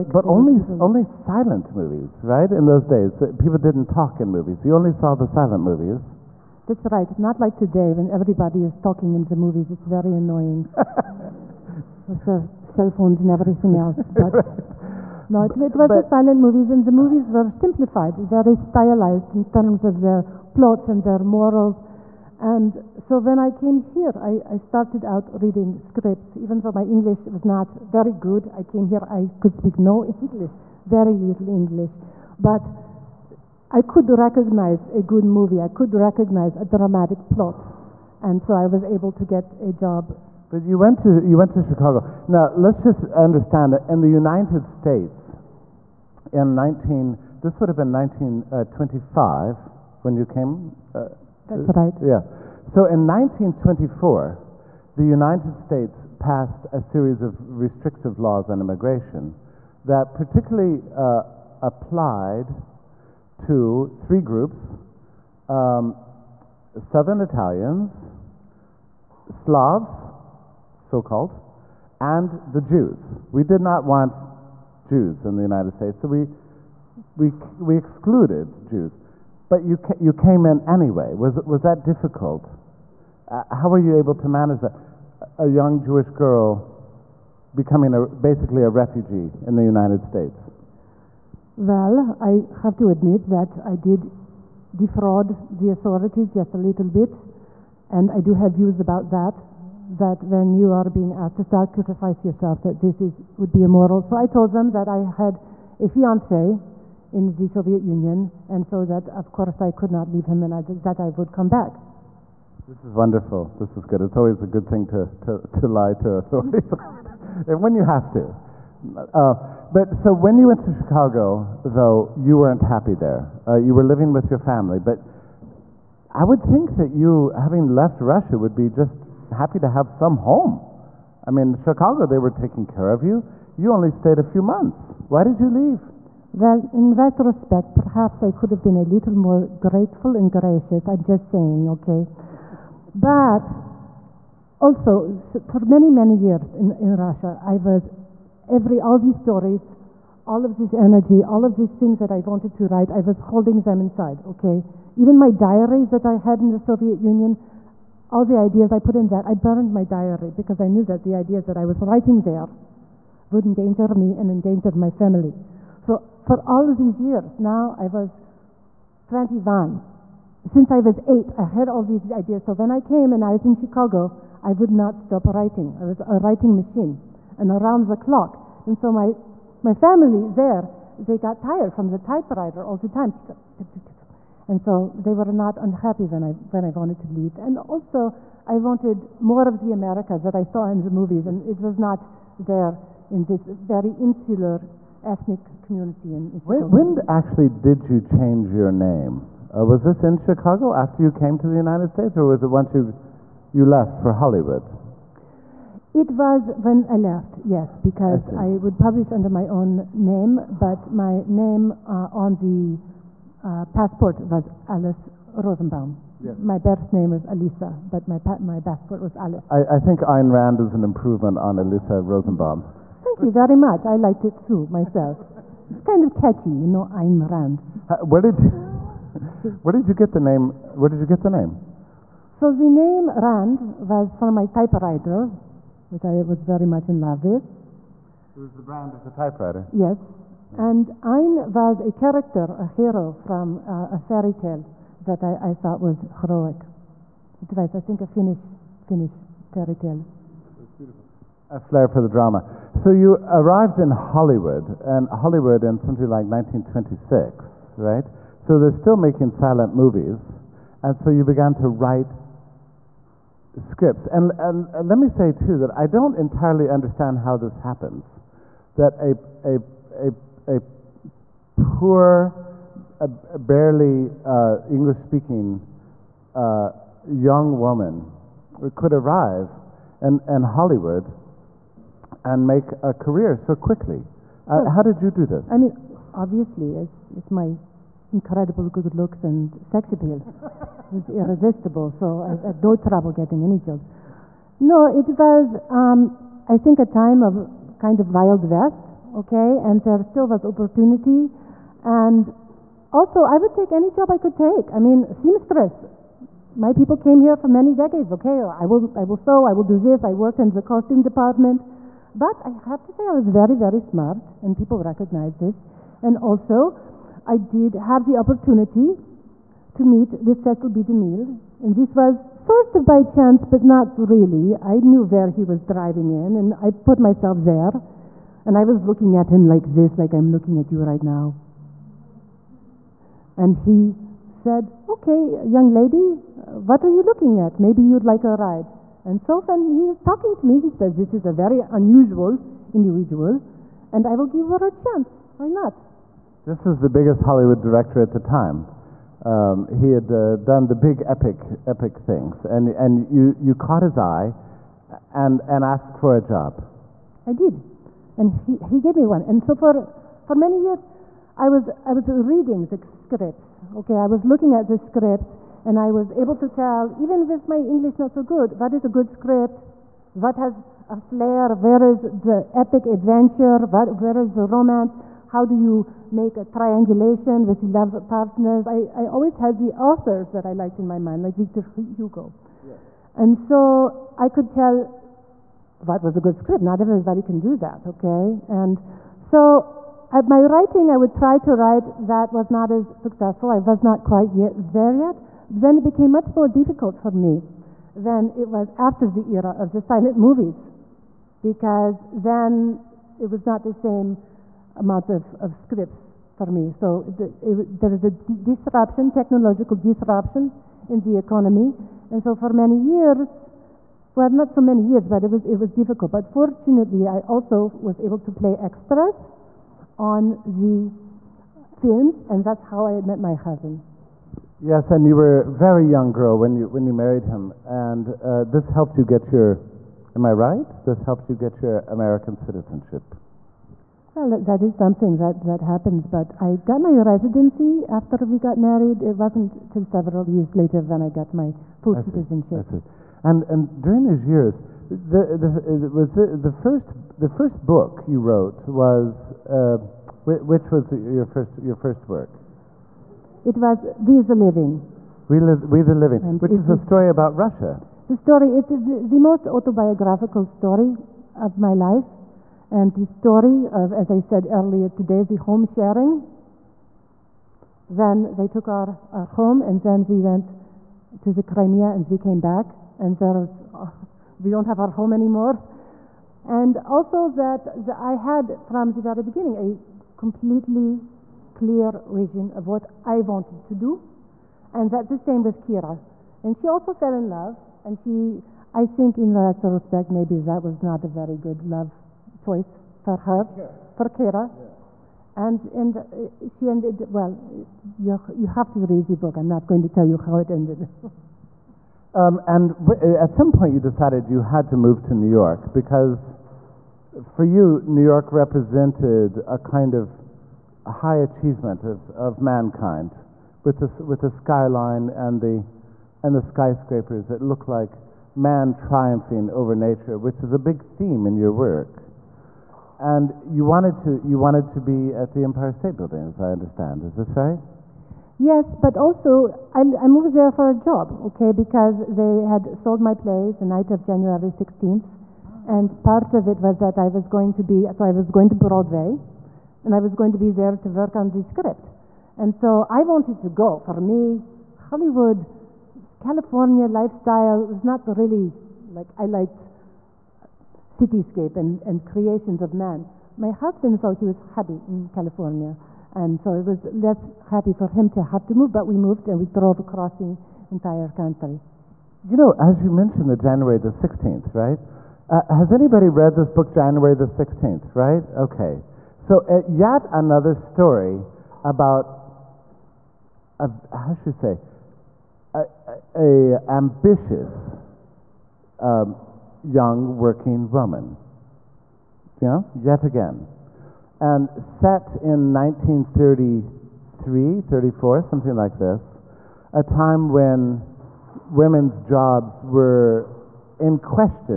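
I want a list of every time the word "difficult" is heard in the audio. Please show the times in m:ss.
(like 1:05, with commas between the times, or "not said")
1:21, 6:36, 6:55.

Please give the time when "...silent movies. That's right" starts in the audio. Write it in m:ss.
0:05.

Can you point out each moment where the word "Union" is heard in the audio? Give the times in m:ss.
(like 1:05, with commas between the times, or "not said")
1:47, 2:36.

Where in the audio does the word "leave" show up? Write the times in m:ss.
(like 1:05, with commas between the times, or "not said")
1:50, 2:15, 3:07.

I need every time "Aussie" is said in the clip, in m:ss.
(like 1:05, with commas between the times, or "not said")
2:28.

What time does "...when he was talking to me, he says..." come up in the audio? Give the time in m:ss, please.
5:39.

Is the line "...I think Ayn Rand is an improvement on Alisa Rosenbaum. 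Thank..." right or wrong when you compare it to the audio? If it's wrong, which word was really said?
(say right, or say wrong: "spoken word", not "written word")
right.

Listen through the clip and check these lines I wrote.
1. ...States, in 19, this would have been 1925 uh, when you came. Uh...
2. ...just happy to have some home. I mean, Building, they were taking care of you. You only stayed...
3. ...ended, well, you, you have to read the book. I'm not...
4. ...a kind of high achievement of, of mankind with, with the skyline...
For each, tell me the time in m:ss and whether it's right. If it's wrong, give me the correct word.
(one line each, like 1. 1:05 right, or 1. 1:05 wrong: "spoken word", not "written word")
1. 0:44 right
2. 2:08 wrong: "Chicago", not "Building"
3. 8:16 right
4. 8:29 right.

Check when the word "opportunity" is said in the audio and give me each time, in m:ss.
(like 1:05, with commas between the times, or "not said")
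5:00, 5:18.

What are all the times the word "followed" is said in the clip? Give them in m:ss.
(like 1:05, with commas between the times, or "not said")
not said.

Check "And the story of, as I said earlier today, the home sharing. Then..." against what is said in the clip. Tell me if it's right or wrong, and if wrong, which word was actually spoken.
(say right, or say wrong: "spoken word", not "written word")
right.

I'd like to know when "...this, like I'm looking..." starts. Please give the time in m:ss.
5:29.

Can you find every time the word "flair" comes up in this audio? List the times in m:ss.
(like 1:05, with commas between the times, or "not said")
4:11, 6:10.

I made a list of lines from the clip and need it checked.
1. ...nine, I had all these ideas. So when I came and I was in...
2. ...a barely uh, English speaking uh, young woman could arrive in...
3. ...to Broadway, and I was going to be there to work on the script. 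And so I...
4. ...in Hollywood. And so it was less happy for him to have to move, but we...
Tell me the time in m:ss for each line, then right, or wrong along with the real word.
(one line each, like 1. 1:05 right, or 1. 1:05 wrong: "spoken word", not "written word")
1. 2:51 wrong: "eight", not "nine"
2. 4:32 right
3. 8:58 right
4. 9:14 wrong: "California", not "Hollywood".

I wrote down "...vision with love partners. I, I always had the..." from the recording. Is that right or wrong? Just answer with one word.
wrong.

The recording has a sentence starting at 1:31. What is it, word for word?
Well, I have to admit that I did defraud the authorities just a little bit, and I do have views about that.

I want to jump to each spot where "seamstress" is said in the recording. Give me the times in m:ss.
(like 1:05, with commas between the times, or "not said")
5:05.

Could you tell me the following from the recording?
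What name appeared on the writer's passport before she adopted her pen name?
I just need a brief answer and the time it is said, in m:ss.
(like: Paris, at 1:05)
Alice Rosenbaum, at 3:34.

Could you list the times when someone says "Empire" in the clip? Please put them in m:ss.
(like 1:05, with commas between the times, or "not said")
8:45.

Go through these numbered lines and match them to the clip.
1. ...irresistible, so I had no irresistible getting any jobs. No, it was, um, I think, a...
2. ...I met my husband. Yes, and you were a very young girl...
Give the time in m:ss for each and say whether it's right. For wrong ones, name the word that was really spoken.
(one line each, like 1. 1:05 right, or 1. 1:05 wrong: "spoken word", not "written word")
1. 4:51 wrong: "trouble", not "irresistible"
2. 7:02 right.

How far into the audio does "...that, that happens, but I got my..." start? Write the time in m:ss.
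7:15.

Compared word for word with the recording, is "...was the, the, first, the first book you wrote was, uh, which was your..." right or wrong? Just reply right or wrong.
right.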